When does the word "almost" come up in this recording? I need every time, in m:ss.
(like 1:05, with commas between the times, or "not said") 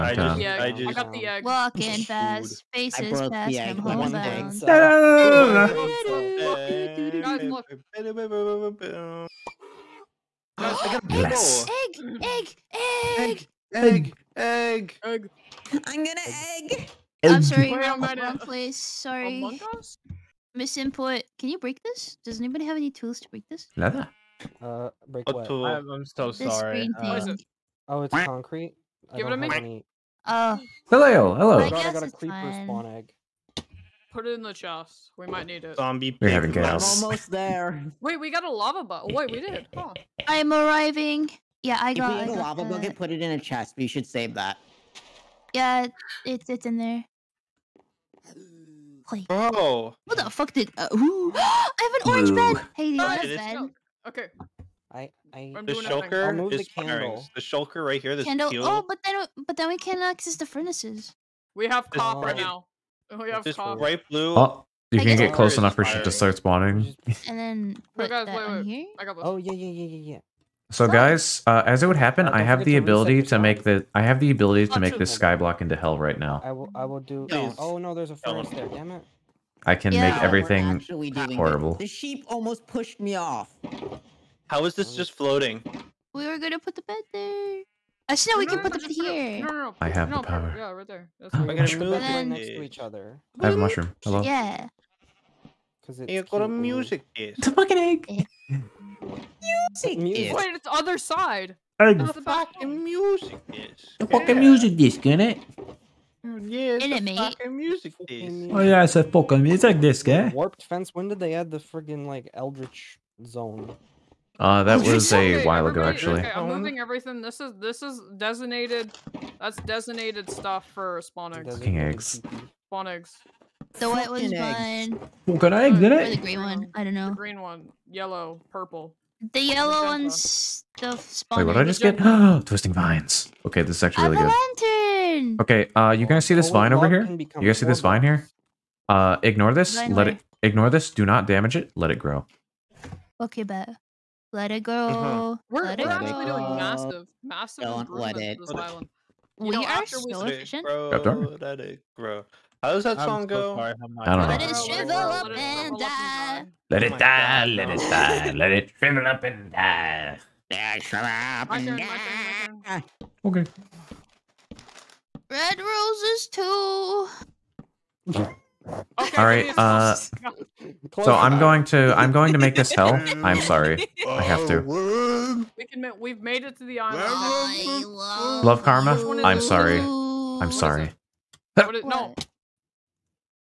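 0:37, 1:22.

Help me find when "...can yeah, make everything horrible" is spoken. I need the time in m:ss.
1:19.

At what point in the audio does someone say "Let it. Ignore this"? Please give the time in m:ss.
2:19.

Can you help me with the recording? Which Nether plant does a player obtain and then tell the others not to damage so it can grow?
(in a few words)
Twisting vines.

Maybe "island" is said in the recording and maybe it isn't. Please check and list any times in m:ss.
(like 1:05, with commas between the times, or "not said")
2:28, 2:56.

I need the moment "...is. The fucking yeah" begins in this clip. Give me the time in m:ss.
1:43.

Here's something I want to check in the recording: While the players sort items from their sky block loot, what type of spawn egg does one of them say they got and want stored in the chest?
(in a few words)
Creeper.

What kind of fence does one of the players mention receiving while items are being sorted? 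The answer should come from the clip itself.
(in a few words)
Warped fence.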